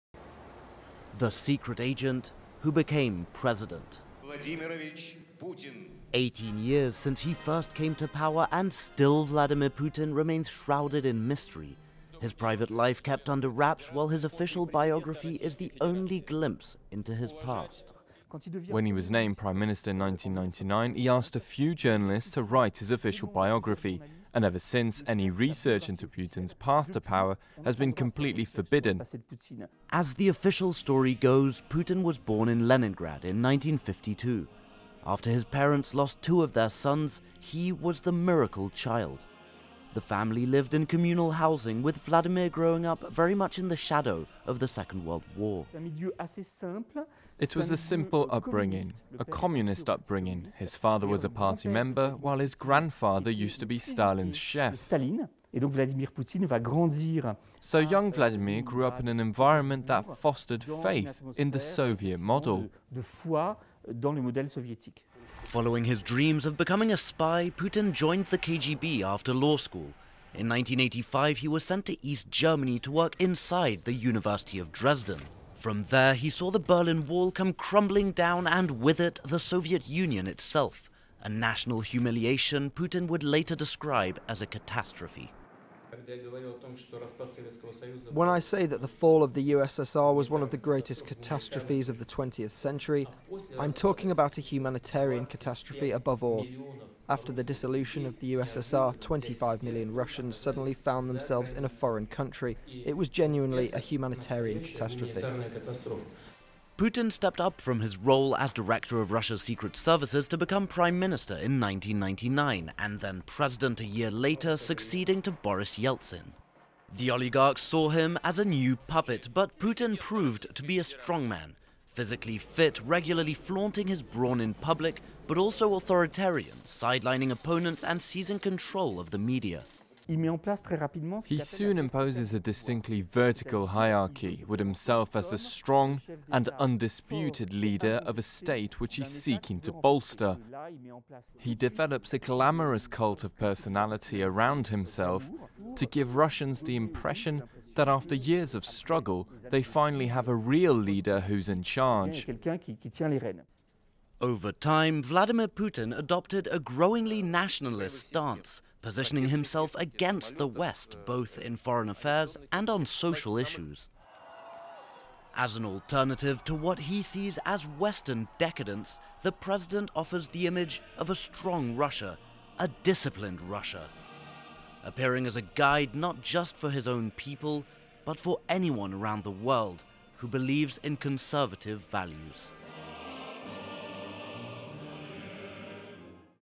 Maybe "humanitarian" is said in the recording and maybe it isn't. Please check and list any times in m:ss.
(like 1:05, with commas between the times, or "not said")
1:34, 1:43.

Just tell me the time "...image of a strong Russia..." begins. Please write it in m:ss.
2:50.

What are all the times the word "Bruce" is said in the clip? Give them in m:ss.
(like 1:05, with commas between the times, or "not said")
not said.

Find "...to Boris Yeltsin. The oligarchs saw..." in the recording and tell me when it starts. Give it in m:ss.
1:55.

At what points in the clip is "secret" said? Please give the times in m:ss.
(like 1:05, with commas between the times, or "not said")
0:01, 1:49.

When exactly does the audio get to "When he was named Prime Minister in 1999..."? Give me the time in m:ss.
0:18.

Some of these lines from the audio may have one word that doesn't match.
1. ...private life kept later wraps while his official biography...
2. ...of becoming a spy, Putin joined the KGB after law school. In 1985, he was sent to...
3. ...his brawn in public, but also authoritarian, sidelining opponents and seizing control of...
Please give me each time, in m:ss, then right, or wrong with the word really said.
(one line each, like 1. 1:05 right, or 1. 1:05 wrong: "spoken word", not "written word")
1. 0:12 wrong: "under", not "later"
2. 1:06 right
3. 2:03 right.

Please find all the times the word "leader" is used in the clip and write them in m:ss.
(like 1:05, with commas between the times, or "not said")
2:17, 2:30.